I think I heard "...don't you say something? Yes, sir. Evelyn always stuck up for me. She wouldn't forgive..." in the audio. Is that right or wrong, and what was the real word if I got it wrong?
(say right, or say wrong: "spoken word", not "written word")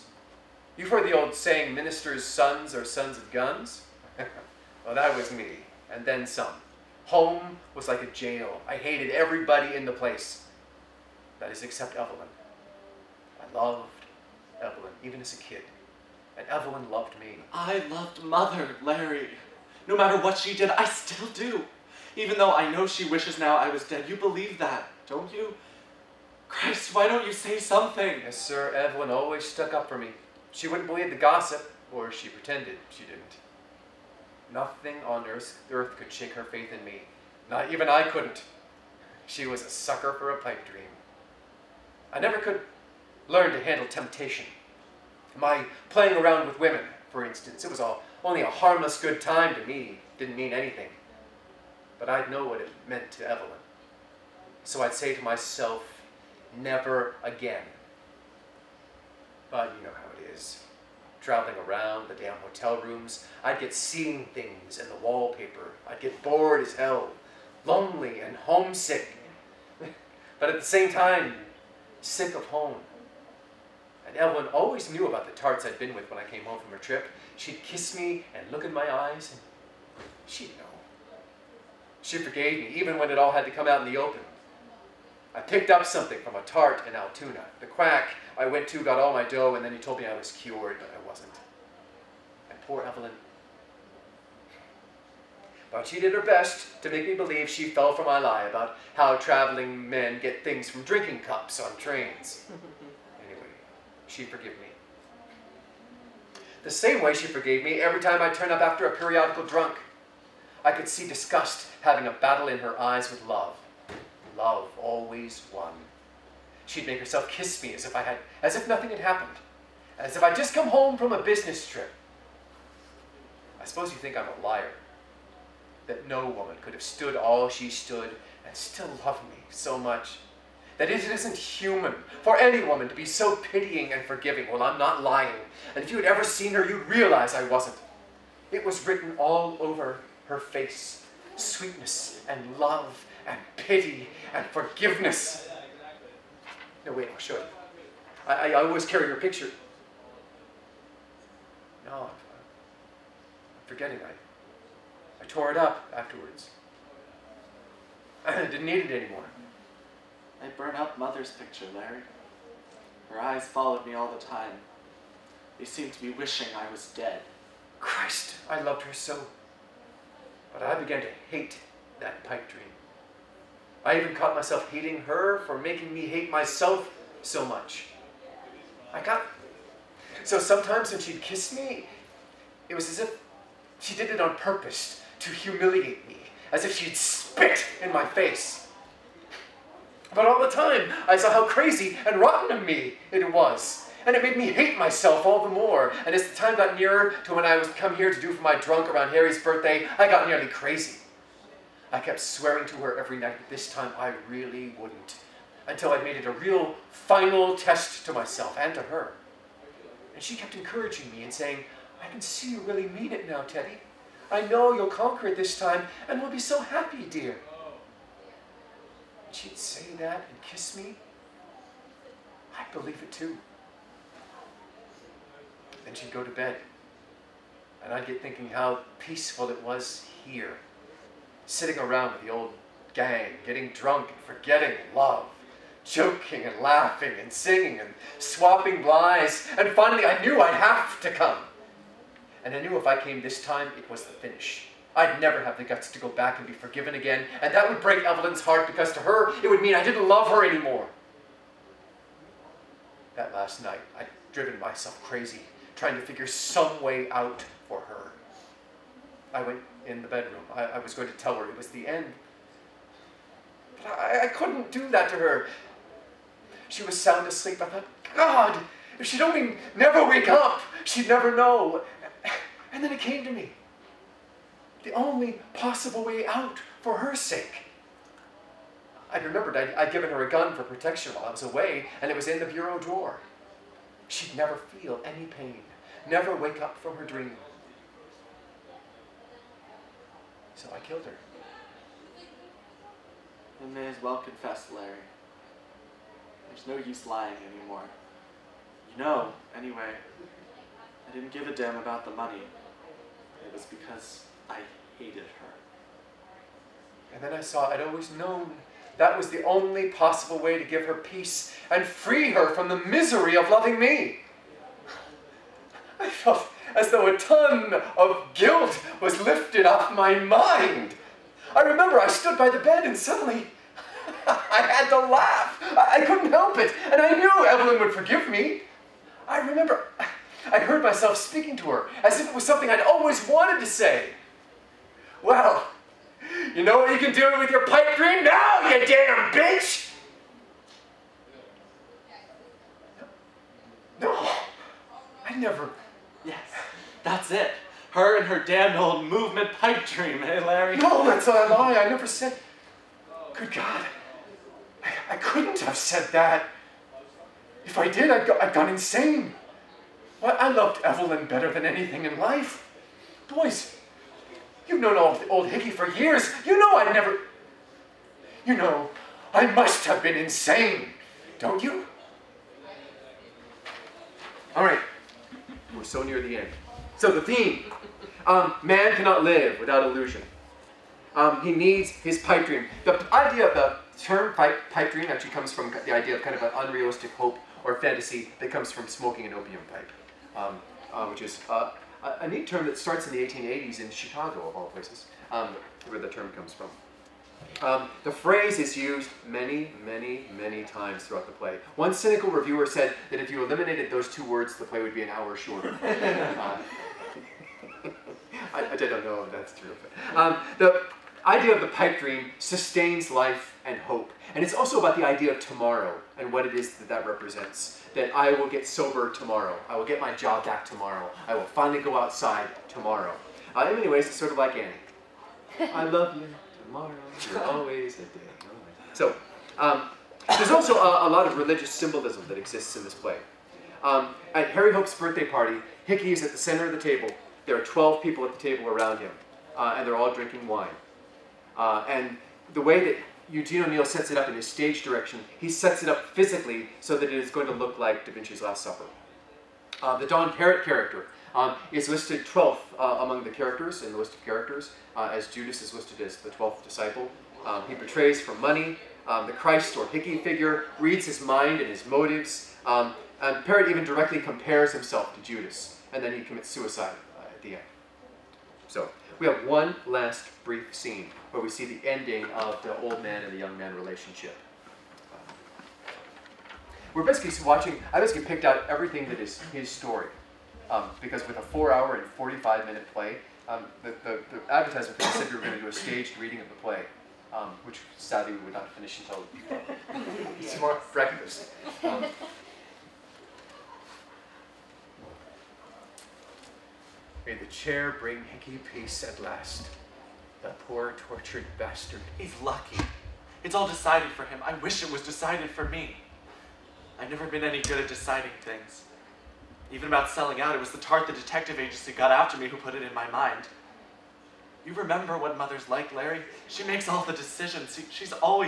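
wrong: "believe", not "forgive".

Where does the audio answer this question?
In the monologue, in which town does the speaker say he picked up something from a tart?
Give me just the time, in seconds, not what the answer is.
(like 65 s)
86 s.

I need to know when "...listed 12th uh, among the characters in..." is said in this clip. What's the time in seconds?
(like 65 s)
451 s.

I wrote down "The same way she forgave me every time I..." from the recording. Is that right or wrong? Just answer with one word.
right.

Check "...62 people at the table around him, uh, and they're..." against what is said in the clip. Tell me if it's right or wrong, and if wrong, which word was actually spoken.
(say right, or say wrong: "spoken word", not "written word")
wrong: "12", not "62".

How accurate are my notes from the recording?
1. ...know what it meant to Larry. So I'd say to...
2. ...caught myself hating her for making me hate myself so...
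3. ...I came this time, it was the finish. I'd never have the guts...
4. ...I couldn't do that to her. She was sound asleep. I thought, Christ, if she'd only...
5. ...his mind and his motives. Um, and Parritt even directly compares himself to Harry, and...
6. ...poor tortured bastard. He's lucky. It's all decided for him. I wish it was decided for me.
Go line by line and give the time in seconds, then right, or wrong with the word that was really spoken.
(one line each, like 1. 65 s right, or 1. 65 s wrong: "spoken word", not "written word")
1. 52 s wrong: "Evelyn", not "Larry"
2. 174 s right
3. 242 s right
4. 264 s wrong: "God", not "Christ"
5. 461 s wrong: "Judas", not "Harry"
6. 500 s right.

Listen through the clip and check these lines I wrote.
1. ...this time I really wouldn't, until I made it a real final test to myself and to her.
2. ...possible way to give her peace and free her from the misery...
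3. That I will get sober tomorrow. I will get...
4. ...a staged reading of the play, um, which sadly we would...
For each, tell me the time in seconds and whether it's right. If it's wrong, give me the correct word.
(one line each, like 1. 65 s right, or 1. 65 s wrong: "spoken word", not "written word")
1. 203 s right
2. 309 s right
3. 417 s right
4. 485 s right.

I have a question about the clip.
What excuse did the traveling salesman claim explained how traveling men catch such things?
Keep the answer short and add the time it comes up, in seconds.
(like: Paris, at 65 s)
drinking cups on trains, at 100 s.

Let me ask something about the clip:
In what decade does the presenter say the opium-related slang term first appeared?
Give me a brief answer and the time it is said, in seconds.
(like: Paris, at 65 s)
1880s, at 393 s.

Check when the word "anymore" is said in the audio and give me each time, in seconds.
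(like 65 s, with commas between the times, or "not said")
159 s, 250 s, 297 s.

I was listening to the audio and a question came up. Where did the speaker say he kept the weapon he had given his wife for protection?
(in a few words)
bureau drawer.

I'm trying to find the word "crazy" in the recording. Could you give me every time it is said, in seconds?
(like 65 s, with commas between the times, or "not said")
191 s, 200 s, 255 s.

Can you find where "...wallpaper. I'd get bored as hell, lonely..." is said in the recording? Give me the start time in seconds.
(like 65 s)
64 s.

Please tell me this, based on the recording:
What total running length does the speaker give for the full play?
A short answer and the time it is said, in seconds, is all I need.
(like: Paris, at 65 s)
4 hours 45 minutes, at 481 s.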